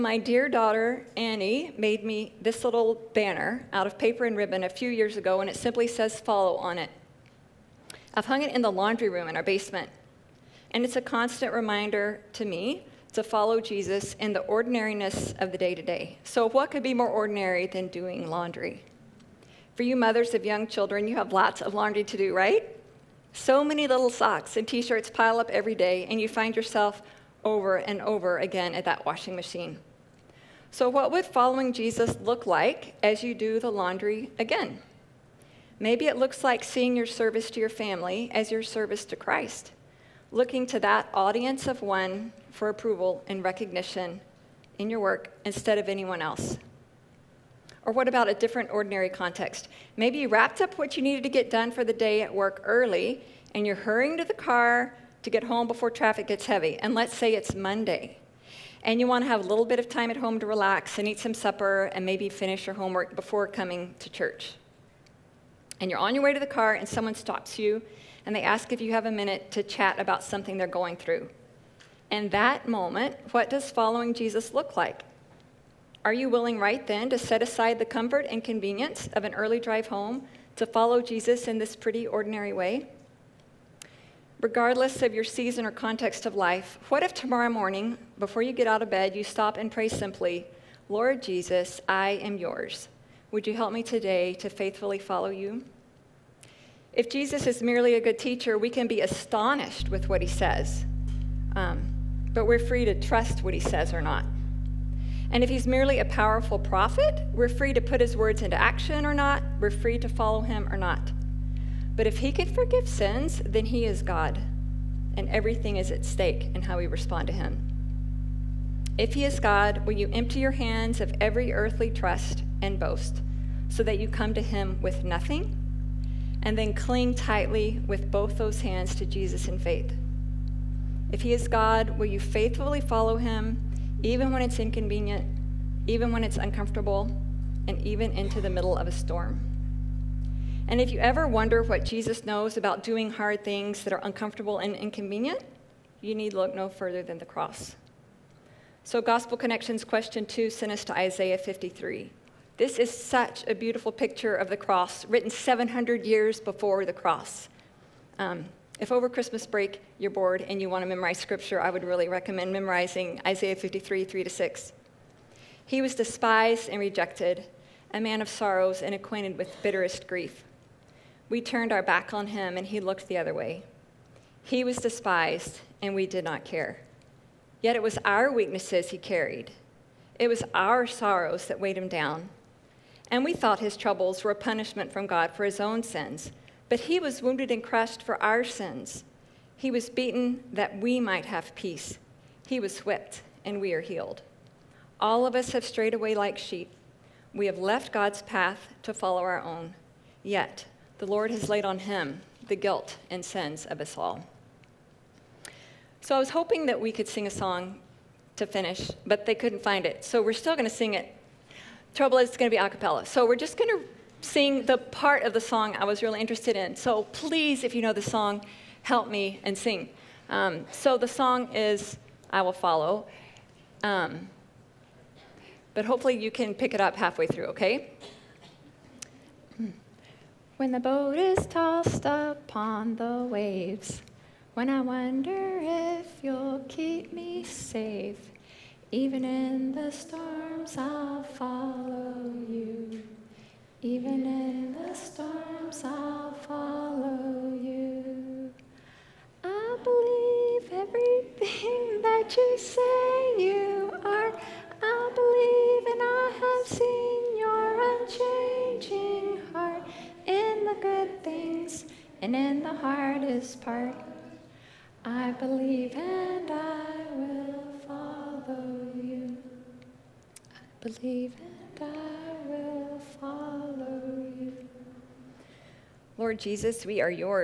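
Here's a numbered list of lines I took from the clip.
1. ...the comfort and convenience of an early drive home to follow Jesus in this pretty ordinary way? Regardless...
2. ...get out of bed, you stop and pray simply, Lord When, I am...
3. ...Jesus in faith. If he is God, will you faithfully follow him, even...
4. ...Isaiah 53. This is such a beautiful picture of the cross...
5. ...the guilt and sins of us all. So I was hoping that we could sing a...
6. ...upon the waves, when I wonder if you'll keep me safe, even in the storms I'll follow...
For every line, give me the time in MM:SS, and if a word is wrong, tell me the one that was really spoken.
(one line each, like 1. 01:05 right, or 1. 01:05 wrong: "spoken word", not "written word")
1. 01:17 right
2. 01:28 wrong: "Jesus", not "When"
3. 02:09 right
4. 02:30 right
5. 03:22 right
6. 03:52 right.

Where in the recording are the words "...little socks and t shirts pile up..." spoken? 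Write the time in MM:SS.
00:23.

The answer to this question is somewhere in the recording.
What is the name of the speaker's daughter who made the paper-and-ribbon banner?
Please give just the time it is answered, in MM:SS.
00:01.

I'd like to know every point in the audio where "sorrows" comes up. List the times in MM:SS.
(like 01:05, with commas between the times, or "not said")
02:48, 03:00.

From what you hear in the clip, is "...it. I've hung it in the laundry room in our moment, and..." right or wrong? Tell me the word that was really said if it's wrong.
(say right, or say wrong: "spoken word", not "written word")
wrong: "basement", not "moment".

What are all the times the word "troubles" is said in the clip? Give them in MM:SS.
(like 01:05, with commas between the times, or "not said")
03:03, 03:31.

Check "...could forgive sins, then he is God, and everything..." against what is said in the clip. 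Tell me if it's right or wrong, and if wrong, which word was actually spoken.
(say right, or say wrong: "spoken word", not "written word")
right.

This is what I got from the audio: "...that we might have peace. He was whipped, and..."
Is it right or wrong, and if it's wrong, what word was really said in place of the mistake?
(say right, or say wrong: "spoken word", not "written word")
right.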